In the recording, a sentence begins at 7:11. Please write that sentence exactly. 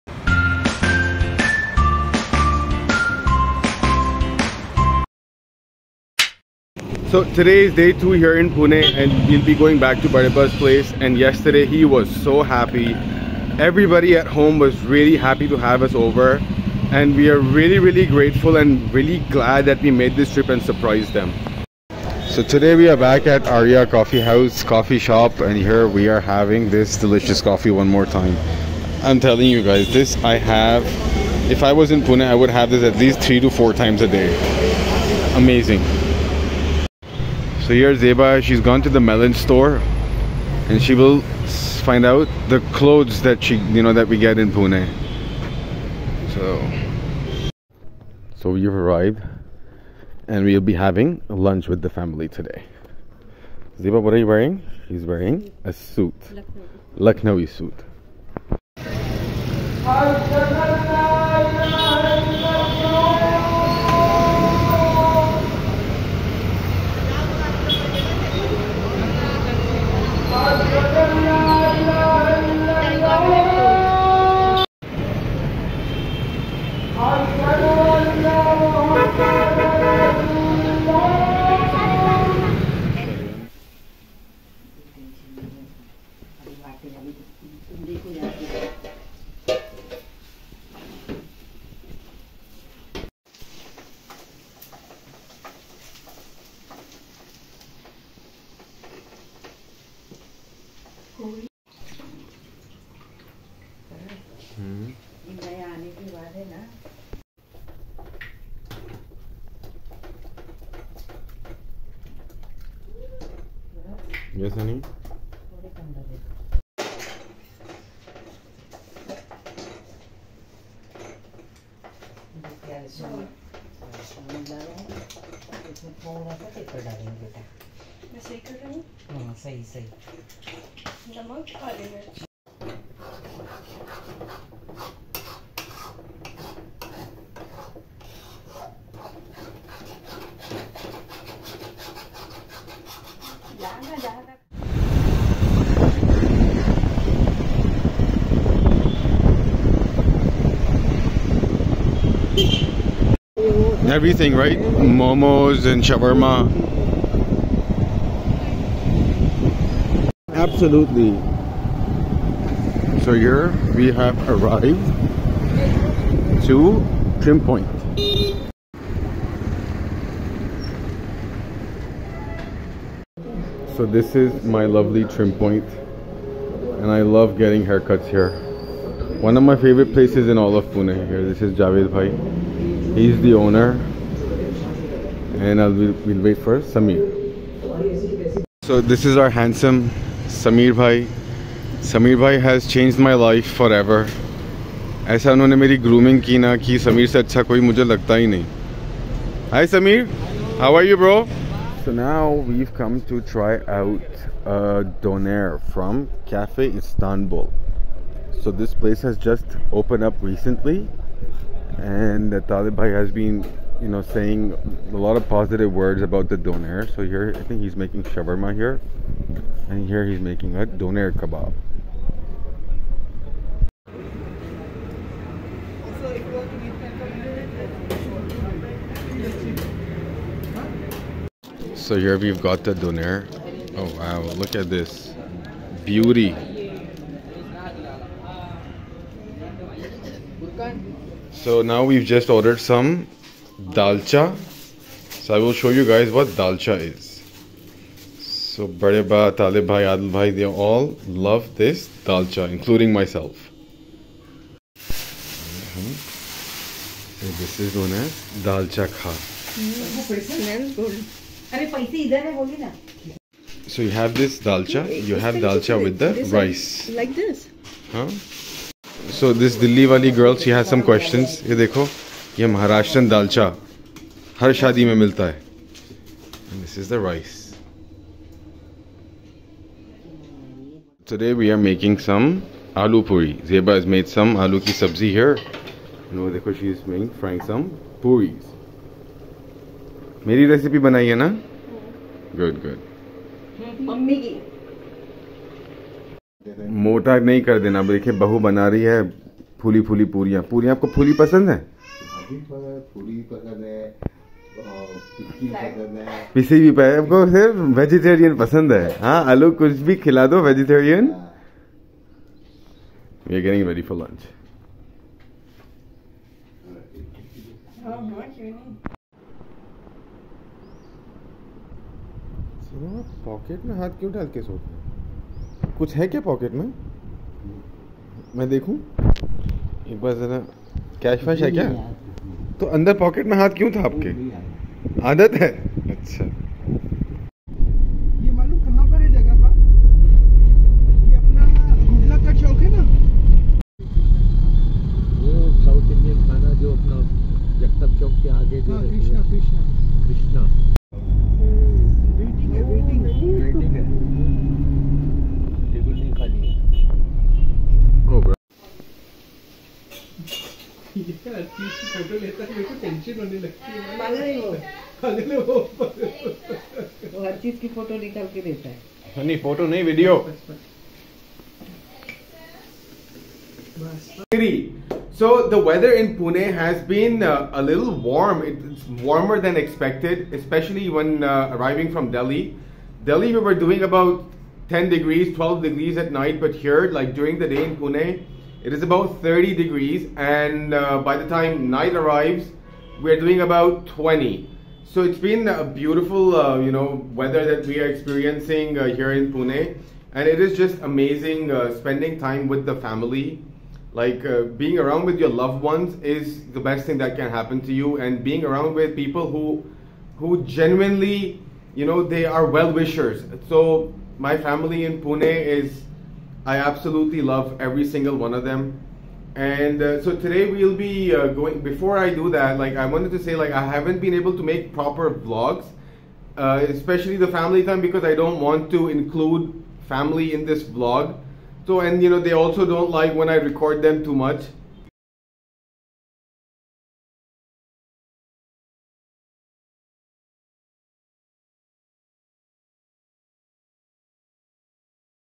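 So and you know they also don't like when I record them too much.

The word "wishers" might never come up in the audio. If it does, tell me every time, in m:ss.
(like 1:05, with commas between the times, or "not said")
6:52.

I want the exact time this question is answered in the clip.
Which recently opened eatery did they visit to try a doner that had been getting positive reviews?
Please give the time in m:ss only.
3:26.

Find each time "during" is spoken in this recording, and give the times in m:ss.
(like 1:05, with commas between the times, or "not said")
6:27.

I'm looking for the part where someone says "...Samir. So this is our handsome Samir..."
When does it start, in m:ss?
3:06.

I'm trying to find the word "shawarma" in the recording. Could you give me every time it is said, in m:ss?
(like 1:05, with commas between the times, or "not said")
2:35, 3:38.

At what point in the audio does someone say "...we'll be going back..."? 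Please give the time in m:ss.
0:09.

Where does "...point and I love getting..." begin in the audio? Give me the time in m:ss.
2:55.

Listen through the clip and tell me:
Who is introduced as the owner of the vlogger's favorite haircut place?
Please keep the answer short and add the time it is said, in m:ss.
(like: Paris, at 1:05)
Javed Bhai, at 3:01.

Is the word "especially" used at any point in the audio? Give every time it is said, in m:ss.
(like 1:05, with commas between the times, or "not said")
6:20, 7:06.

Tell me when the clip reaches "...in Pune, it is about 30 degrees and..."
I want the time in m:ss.
6:27.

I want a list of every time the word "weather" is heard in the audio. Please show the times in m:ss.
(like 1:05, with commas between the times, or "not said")
6:15, 6:37.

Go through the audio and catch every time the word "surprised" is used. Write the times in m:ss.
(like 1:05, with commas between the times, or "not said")
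0:20.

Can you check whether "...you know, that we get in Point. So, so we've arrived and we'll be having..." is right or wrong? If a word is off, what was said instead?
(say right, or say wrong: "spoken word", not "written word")
wrong: "Pune", not "Point".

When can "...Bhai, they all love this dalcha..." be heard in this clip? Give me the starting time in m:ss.
4:10.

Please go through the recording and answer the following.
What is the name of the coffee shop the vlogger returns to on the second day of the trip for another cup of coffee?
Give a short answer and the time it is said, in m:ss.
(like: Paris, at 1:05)
Arya Coffee House, at 0:23.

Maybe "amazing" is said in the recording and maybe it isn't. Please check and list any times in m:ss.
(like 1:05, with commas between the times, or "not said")
0:35, 6:40.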